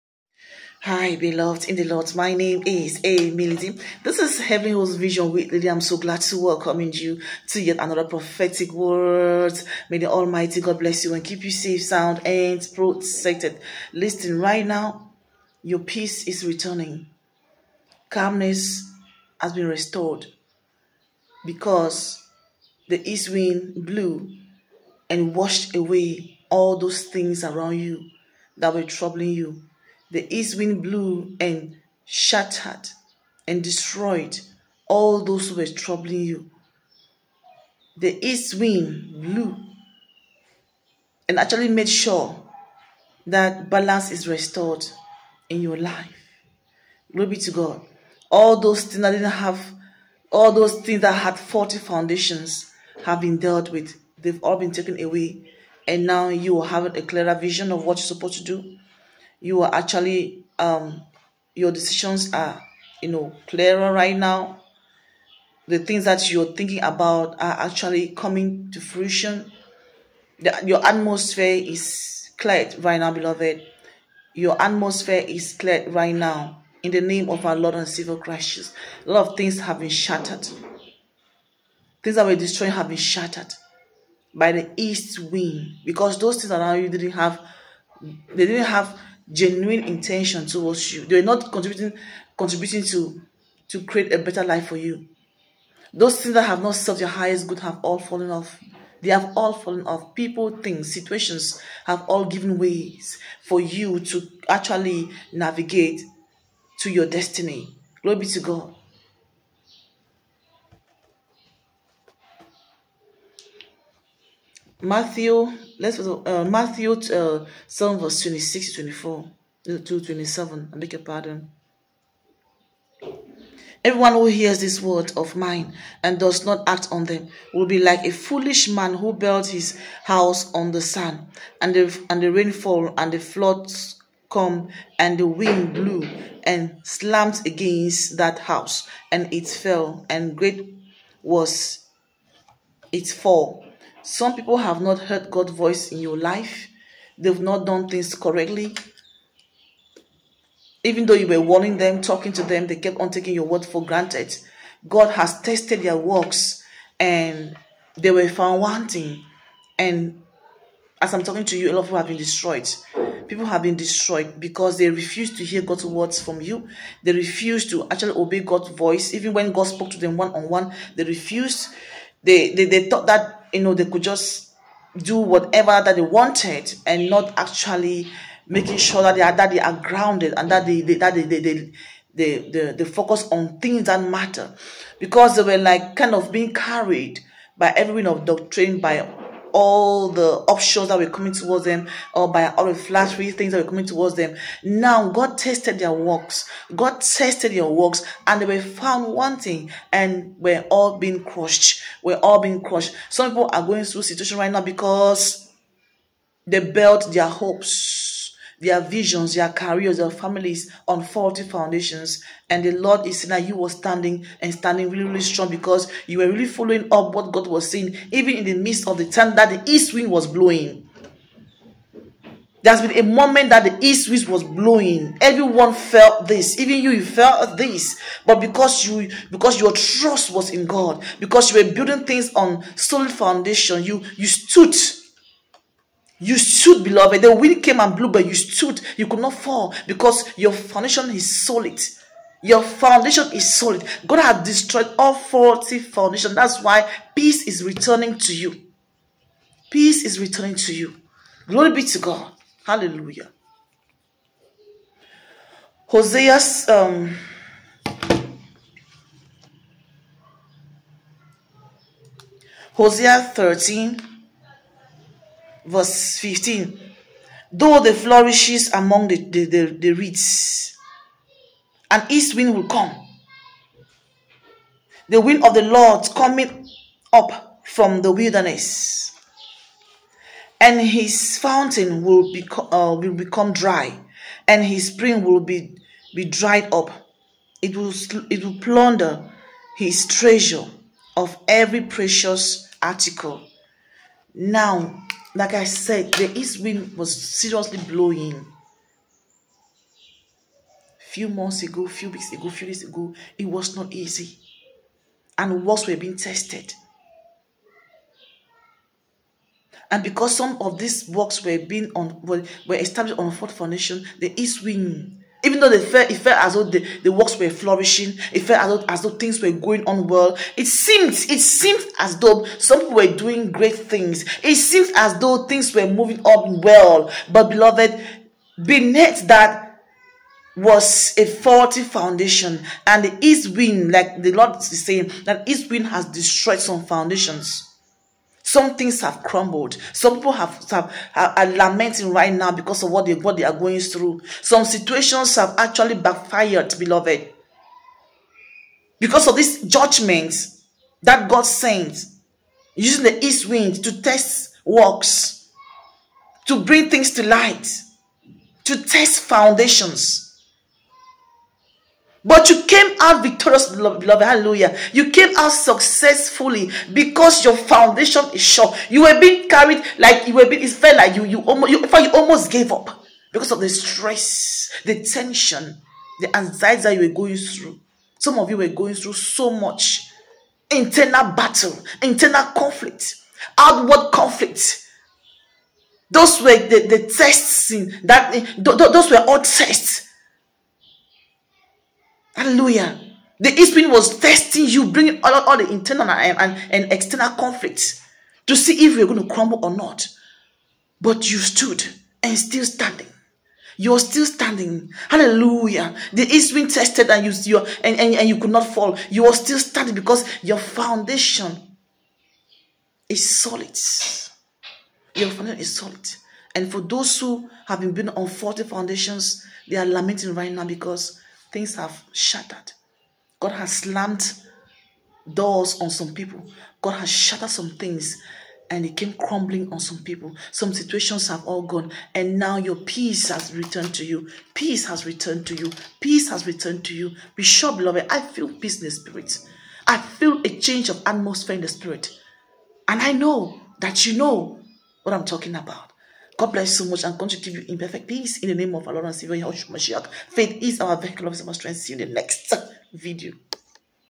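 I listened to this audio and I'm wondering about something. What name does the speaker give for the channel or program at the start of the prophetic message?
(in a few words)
Heavenly Host Vision With Lidi.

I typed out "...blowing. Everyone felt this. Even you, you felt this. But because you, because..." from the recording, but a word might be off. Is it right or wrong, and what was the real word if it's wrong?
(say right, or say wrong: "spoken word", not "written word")
right.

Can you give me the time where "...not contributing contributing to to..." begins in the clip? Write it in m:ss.
1:31.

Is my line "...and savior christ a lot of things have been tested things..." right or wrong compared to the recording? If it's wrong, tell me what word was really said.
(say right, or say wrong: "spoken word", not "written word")
wrong: "shattered", not "tested".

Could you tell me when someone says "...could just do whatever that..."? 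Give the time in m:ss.
2:53.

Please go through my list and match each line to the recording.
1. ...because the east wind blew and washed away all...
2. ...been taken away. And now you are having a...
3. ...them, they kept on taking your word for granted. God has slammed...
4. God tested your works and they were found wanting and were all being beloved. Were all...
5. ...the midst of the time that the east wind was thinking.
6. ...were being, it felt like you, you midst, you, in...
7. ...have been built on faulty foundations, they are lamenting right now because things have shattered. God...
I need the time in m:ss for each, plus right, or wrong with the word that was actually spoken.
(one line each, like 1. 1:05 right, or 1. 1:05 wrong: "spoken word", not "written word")
1. 0:21 right
2. 0:54 right
3. 2:32 wrong: "tested", not "slammed"
4. 3:16 wrong: "crushed", not "beloved"
5. 3:38 wrong: "blowing", not "thinking"
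6. 6:10 wrong: "almost", not "midst"
7. 6:57 right.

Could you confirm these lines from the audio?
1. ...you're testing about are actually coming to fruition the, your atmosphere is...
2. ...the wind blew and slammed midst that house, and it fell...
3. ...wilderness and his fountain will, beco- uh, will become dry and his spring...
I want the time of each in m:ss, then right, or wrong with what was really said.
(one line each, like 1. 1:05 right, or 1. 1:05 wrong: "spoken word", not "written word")
1. 1:06 wrong: "thinking", not "testing"
2. 2:15 wrong: "against", not "midst"
3. 4:38 right.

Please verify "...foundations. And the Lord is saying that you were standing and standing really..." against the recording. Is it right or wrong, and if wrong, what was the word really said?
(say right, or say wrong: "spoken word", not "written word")
right.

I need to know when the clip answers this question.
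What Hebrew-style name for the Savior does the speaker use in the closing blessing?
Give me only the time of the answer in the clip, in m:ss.
7:29.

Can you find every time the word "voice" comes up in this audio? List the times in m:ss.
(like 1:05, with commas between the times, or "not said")
2:25, 2:48.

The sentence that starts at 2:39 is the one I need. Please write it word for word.
And as I'm talking to you, a lot of people have been destroyed.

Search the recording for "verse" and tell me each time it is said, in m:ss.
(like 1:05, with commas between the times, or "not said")
1:57, 4:25.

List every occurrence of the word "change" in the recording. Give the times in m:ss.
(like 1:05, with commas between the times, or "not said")
7:20.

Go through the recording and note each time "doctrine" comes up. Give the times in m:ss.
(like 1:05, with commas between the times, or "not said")
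3:08.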